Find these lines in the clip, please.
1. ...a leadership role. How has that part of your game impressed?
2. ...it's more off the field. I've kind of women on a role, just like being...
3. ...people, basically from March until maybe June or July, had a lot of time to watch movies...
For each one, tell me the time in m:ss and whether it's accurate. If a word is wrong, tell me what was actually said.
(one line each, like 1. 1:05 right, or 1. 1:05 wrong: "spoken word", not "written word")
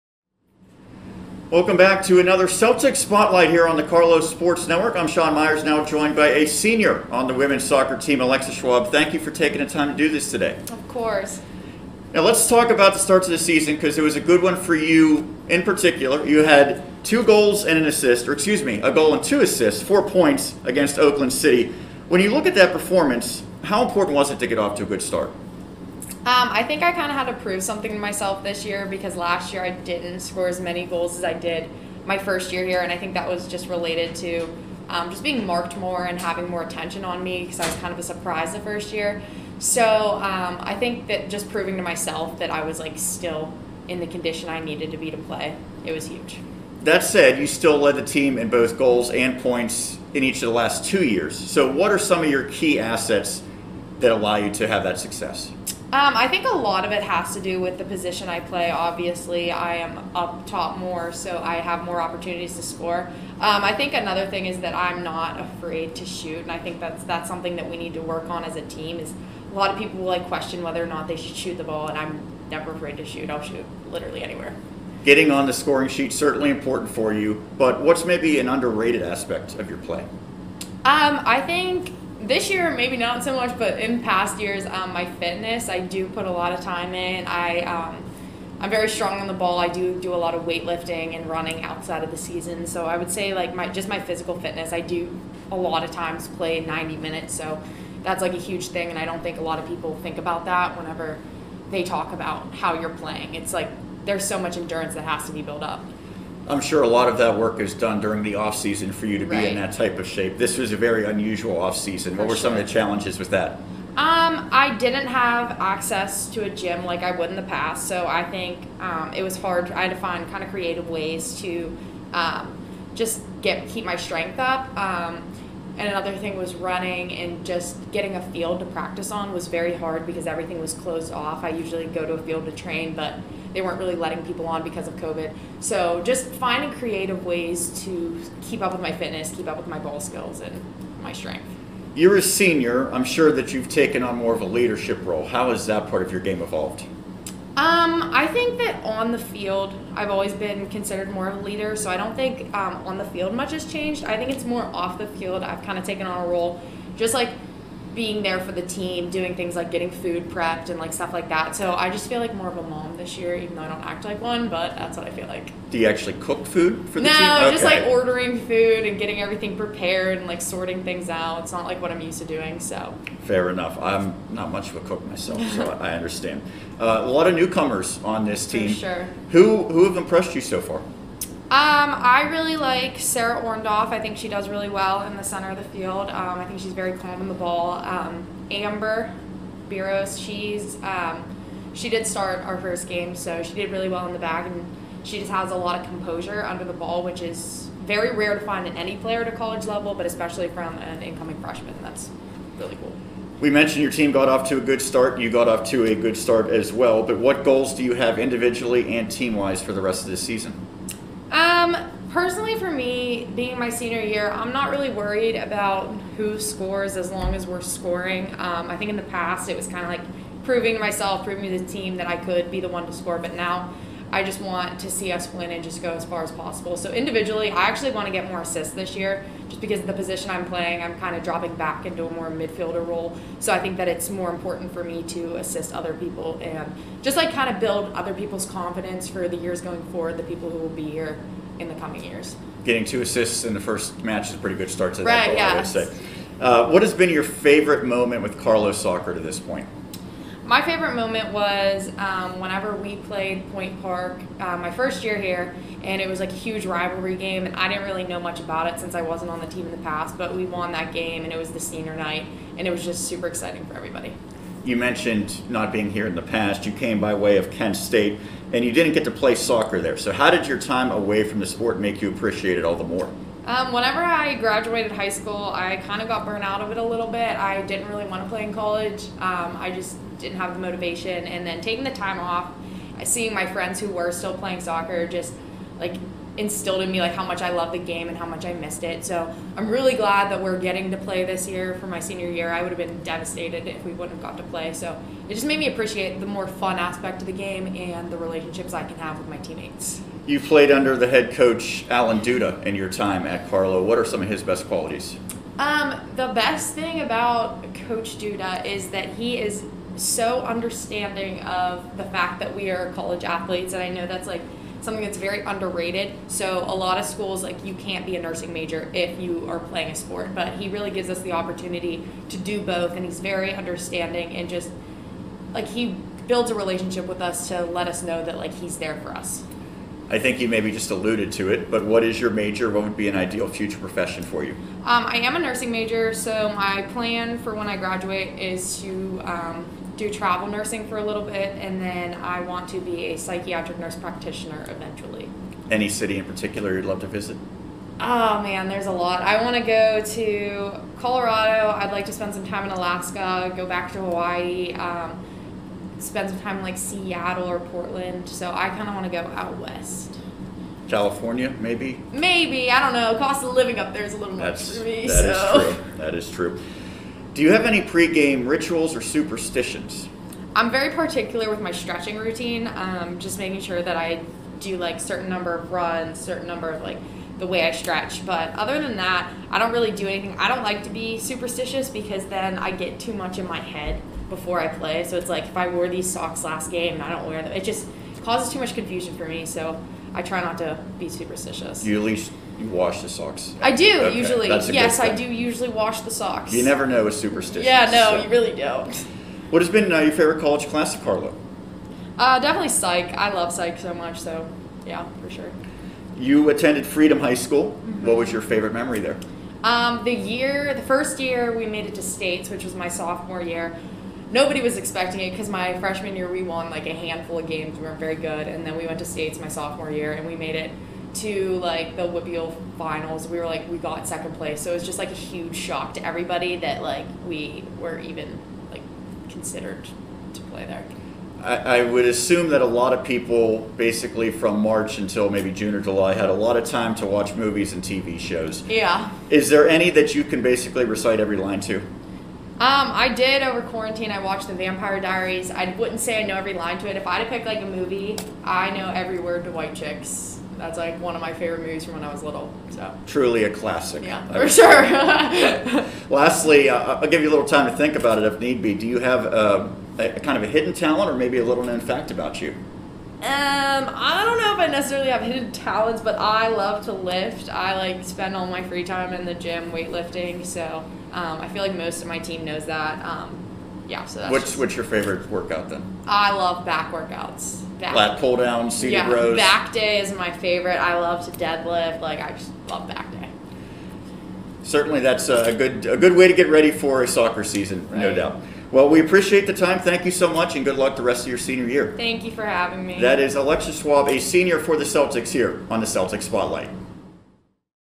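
1. 2:24 wrong: "evolved", not "impressed"
2. 2:34 wrong: "taken", not "women"
3. 7:13 right.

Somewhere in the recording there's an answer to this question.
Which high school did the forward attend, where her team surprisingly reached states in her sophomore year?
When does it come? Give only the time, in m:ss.
6:46.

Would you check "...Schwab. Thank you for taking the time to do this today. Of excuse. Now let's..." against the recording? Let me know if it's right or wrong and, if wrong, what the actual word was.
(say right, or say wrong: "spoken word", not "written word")
wrong: "course", not "excuse".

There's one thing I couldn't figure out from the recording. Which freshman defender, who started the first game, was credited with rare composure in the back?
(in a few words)
Amber Biros.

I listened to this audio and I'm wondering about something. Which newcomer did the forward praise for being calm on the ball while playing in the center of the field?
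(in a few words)
Sarah Orndorff.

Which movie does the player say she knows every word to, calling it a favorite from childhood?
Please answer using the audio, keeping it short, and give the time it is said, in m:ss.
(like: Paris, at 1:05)
White Chicks, at 7:29.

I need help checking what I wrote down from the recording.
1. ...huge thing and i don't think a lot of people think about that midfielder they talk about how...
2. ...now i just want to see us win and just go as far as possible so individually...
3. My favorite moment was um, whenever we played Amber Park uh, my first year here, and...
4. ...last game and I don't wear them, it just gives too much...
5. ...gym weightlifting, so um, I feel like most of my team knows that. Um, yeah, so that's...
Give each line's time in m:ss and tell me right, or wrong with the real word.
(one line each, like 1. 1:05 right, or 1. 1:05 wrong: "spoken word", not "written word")
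1. 1:38 wrong: "whenever", not "midfielder"
2. 3:43 right
3. 4:10 wrong: "Point", not "Amber"
4. 6:26 wrong: "causes", not "gives"
5. 7:49 right.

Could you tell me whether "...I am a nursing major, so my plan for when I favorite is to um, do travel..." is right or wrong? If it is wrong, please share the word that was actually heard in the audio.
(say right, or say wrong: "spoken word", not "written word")
wrong: "graduate", not "favorite".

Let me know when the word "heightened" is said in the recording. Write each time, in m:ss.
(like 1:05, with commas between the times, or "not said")
not said.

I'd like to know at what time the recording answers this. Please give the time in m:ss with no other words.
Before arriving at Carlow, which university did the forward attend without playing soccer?
4:27.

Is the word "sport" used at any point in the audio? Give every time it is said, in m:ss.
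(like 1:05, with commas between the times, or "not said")
0:04, 4:31, 5:19.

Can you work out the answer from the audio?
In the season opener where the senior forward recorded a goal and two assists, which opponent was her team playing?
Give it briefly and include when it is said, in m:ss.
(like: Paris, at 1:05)
Oakland City, at 0:20.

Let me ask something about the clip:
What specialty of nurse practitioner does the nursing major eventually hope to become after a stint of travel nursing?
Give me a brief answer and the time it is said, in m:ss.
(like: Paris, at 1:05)
psychiatric, at 5:43.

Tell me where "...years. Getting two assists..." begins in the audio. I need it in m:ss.
4:02.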